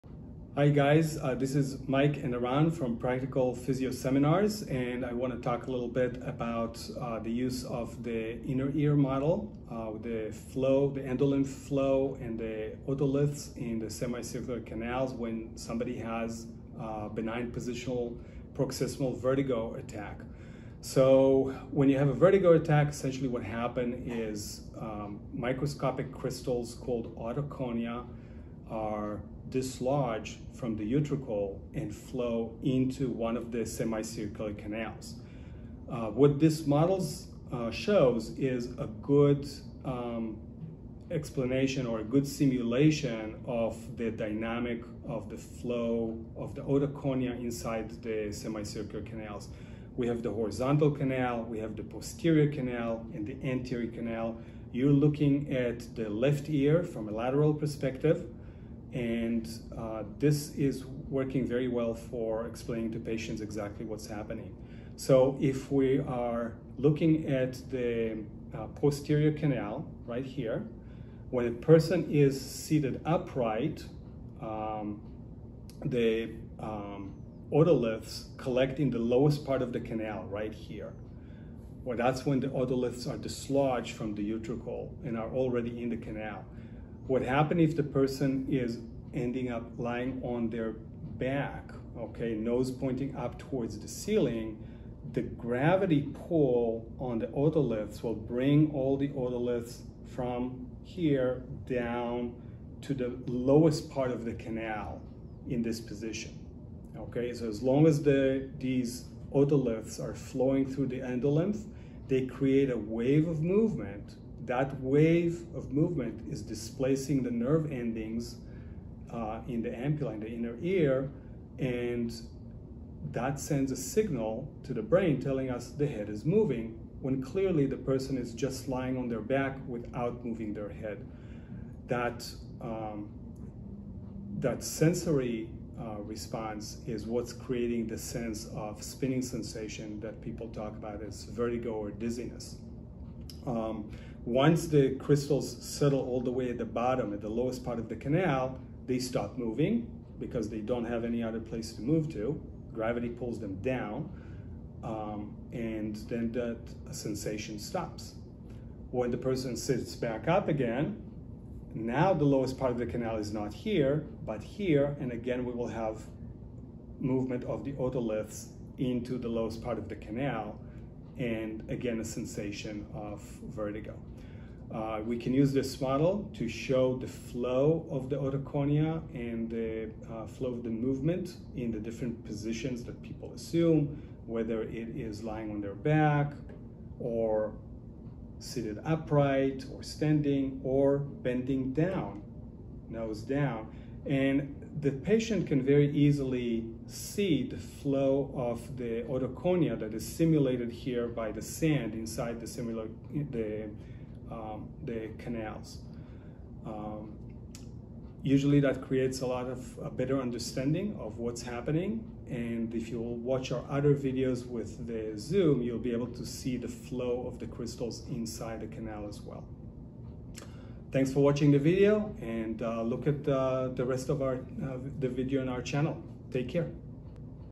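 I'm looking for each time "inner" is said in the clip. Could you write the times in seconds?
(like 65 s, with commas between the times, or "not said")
8 s, 120 s.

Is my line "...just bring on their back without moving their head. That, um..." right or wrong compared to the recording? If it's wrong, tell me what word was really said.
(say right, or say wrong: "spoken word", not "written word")
wrong: "lying", not "bring".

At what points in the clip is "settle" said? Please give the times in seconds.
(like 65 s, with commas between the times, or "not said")
145 s.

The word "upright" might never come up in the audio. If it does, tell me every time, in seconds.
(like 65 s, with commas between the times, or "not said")
73 s, 188 s.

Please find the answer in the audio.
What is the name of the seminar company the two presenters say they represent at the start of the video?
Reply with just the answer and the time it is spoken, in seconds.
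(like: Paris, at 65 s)
Practical Physio Seminars, at 2 s.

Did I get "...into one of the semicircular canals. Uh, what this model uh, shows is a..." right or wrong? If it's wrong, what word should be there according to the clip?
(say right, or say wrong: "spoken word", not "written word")
right.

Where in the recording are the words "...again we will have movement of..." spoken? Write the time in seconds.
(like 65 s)
165 s.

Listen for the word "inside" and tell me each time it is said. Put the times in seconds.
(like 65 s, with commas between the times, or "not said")
47 s, 201 s, 218 s.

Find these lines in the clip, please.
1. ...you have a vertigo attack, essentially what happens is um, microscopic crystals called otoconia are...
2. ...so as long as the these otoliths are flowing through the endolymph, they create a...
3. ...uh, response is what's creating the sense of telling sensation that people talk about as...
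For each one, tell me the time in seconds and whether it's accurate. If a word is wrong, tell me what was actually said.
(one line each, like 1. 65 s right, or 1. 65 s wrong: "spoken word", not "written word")
1. 21 s right
2. 107 s right
3. 135 s wrong: "spinning", not "telling".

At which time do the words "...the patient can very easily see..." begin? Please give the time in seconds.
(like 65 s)
194 s.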